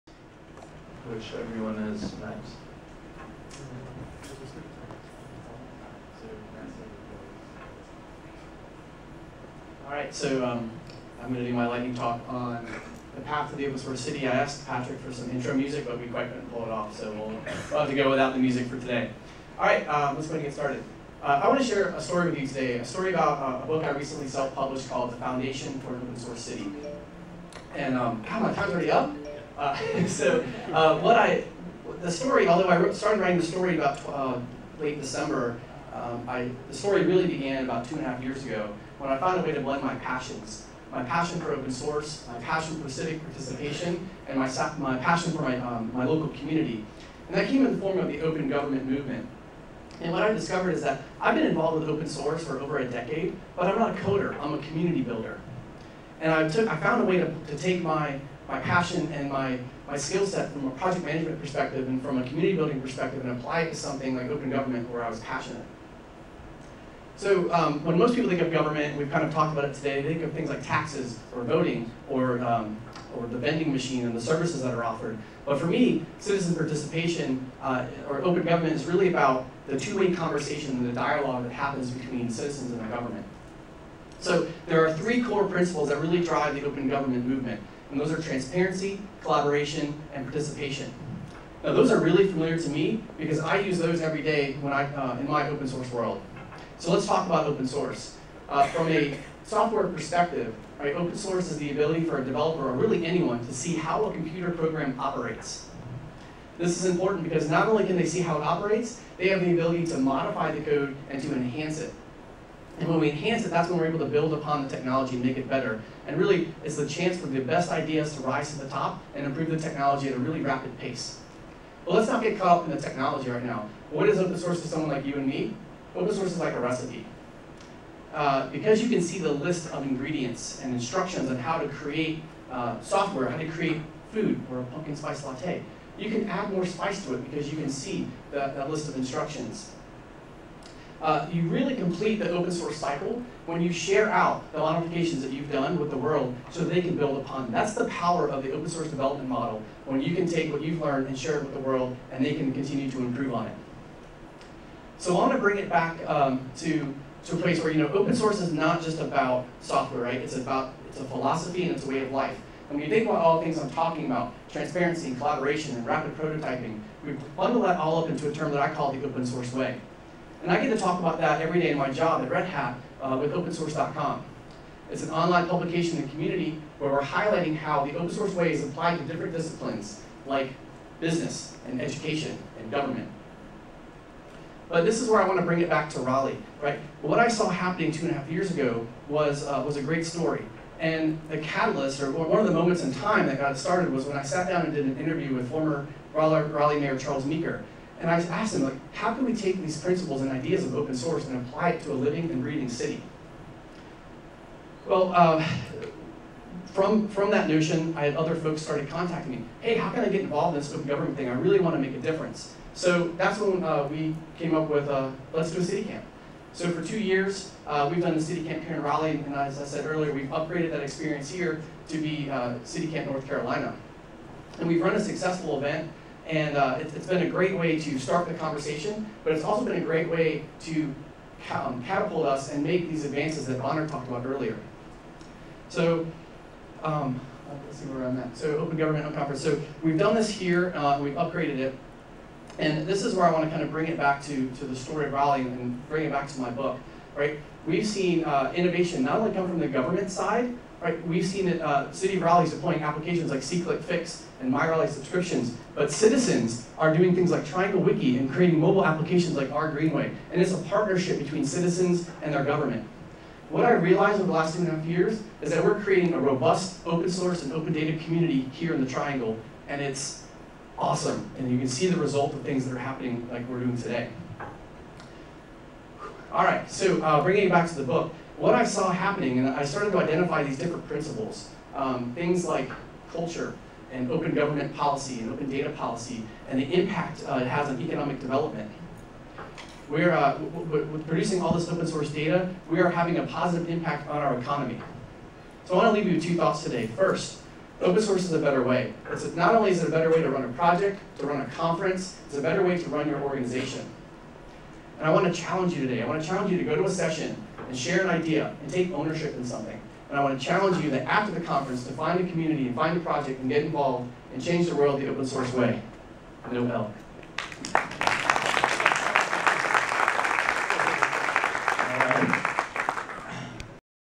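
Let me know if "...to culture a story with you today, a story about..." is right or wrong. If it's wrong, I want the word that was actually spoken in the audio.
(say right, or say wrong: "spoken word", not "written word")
wrong: "share", not "culture".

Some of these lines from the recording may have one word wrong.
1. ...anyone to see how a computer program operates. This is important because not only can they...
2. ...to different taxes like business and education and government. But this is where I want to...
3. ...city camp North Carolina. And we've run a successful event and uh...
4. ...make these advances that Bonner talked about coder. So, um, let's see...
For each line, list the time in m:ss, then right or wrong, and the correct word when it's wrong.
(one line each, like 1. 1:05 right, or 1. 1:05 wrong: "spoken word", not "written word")
1. 1:43 right
2. 2:58 wrong: "disciplines", not "taxes"
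3. 3:42 right
4. 3:52 wrong: "earlier", not "coder".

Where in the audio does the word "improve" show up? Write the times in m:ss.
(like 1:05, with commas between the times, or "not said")
1:59, 2:32.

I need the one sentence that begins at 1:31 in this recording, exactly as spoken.
Now those are really familiar to me because I use those every day when I, uh, in my open source world.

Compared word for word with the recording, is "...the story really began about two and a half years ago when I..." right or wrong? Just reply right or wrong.
right.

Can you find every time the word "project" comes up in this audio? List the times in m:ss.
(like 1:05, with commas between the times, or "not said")
1:00, 5:00, 5:12.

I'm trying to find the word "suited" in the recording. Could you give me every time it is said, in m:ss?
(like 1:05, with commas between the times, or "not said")
not said.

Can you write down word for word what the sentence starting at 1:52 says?
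And when we enhance it, that's when we're able to build upon the technology and make it better.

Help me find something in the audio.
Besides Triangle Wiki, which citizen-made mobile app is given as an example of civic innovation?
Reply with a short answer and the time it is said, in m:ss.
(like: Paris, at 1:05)
R Greenway, at 4:19.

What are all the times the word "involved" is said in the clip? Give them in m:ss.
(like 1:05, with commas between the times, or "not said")
0:51, 3:30, 5:13.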